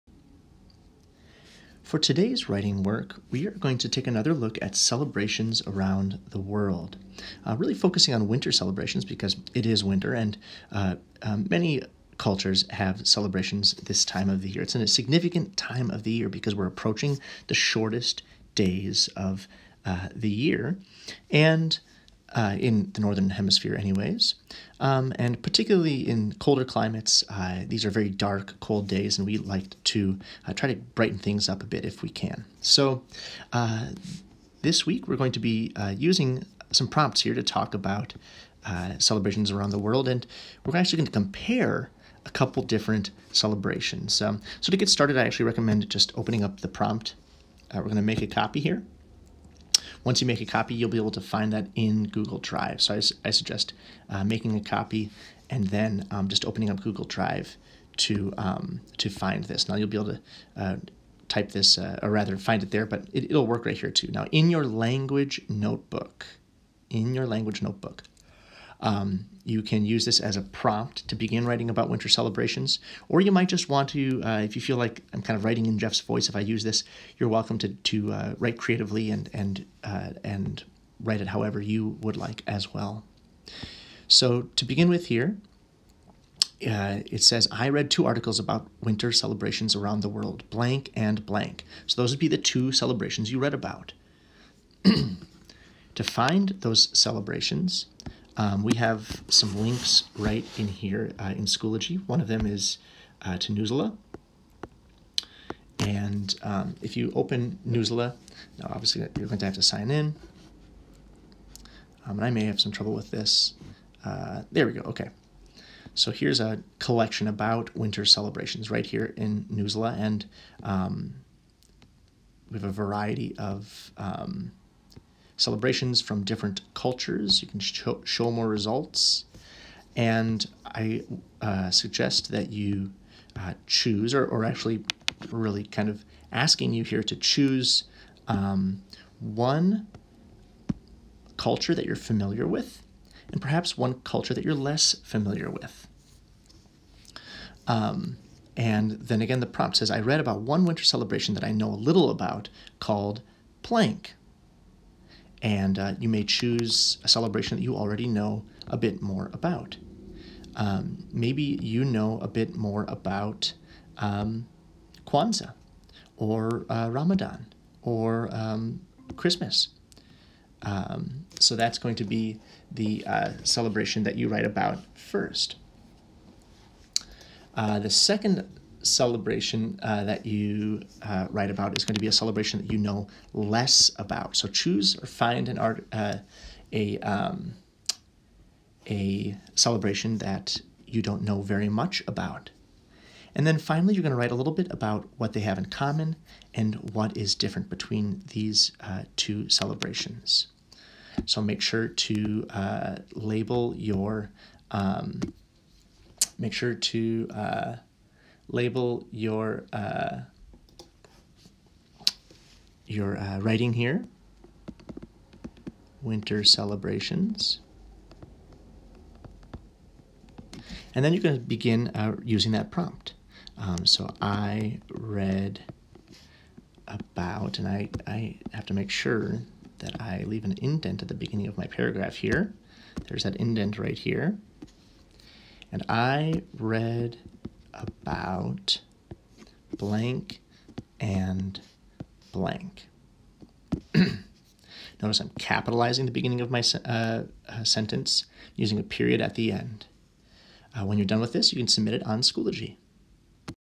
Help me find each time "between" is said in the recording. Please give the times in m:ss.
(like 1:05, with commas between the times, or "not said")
3:17.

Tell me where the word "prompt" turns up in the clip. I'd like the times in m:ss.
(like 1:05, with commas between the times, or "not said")
0:36, 0:46, 1:10, 2:29, 3:42.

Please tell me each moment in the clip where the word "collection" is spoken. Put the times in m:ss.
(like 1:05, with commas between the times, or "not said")
1:56.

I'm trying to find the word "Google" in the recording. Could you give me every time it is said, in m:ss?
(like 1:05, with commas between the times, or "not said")
0:52, 0:56.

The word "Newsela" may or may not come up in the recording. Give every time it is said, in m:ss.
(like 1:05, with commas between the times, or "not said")
1:43, 1:47, 1:59.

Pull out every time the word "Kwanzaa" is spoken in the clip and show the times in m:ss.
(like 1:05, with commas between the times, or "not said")
2:45.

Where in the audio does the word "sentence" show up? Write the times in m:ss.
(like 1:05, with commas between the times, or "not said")
4:07.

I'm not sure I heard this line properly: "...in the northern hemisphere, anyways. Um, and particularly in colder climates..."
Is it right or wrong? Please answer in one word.
right.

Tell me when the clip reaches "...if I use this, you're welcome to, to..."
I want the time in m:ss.
1:16.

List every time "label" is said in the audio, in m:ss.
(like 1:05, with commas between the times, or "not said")
3:23, 3:28.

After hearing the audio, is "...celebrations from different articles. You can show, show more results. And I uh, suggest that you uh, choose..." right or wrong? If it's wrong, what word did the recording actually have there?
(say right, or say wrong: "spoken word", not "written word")
wrong: "cultures", not "articles".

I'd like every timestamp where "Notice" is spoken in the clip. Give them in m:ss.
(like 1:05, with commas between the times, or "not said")
4:05.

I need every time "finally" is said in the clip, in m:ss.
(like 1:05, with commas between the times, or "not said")
3:13.